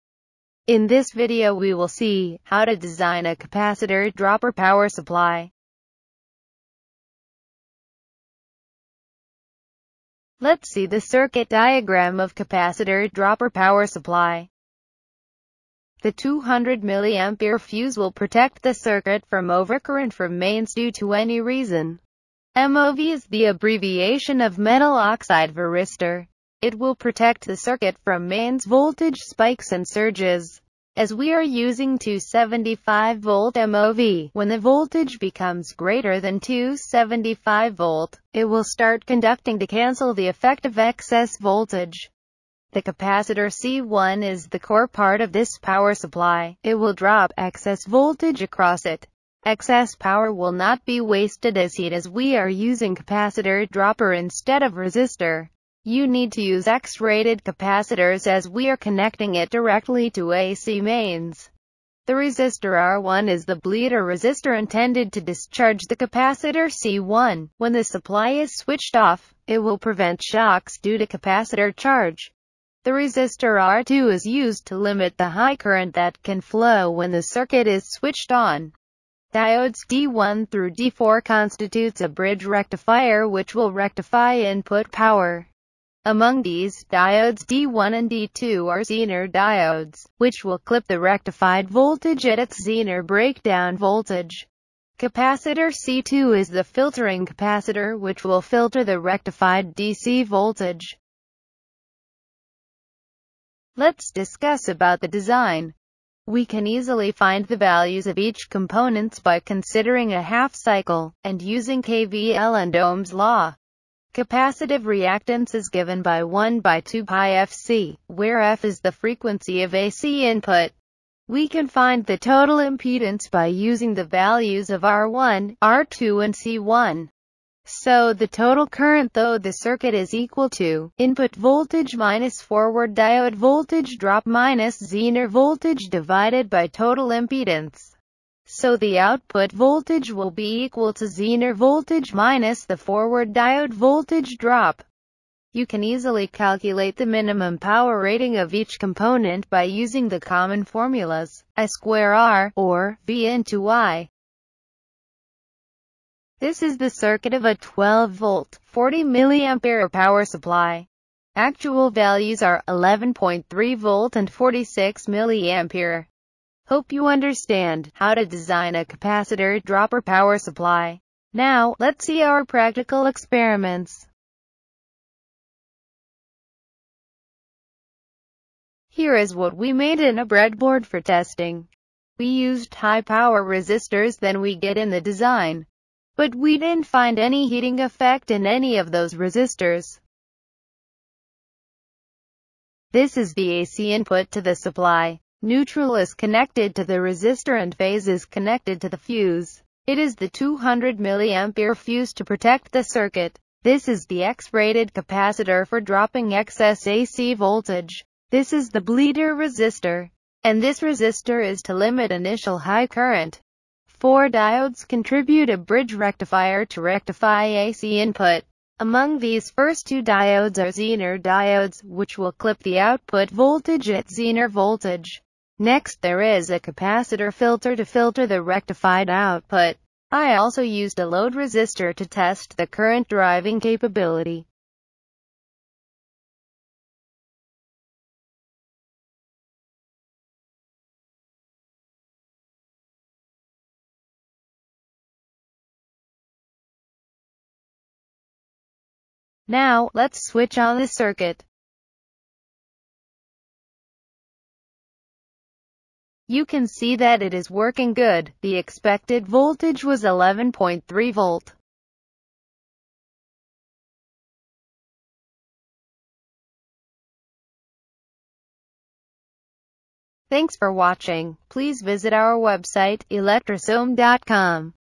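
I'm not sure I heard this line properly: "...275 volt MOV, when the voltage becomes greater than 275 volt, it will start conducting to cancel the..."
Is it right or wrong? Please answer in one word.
right.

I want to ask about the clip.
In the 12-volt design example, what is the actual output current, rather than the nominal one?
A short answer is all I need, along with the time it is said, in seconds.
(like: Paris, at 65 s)
46 mA, at 164 s.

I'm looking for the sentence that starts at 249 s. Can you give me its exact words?
Now, let's switch on the circuit.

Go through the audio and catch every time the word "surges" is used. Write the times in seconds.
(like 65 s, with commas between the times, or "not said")
29 s.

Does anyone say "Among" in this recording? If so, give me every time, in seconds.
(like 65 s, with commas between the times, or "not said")
86 s, 218 s.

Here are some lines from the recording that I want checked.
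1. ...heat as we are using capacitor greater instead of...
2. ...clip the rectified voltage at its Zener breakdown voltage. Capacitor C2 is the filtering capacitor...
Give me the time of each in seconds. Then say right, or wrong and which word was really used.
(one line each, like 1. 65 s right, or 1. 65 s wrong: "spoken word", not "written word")
1. 51 s wrong: "dropper", not "greater"
2. 90 s right.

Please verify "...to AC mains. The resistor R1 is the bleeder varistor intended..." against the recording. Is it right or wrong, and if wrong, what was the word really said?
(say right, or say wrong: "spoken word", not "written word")
wrong: "resistor", not "varistor".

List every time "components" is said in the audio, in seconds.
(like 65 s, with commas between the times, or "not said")
108 s, 148 s.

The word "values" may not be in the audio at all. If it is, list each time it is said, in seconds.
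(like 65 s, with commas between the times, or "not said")
107 s, 124 s, 161 s.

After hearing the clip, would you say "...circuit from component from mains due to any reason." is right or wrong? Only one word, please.
wrong.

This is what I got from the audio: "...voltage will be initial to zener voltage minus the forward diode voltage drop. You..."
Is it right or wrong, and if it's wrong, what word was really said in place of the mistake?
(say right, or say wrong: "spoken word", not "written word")
wrong: "equal", not "initial".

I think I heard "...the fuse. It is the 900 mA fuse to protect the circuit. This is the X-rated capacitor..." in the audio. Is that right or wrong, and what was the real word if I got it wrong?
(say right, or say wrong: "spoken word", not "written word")
wrong: "200", not "900".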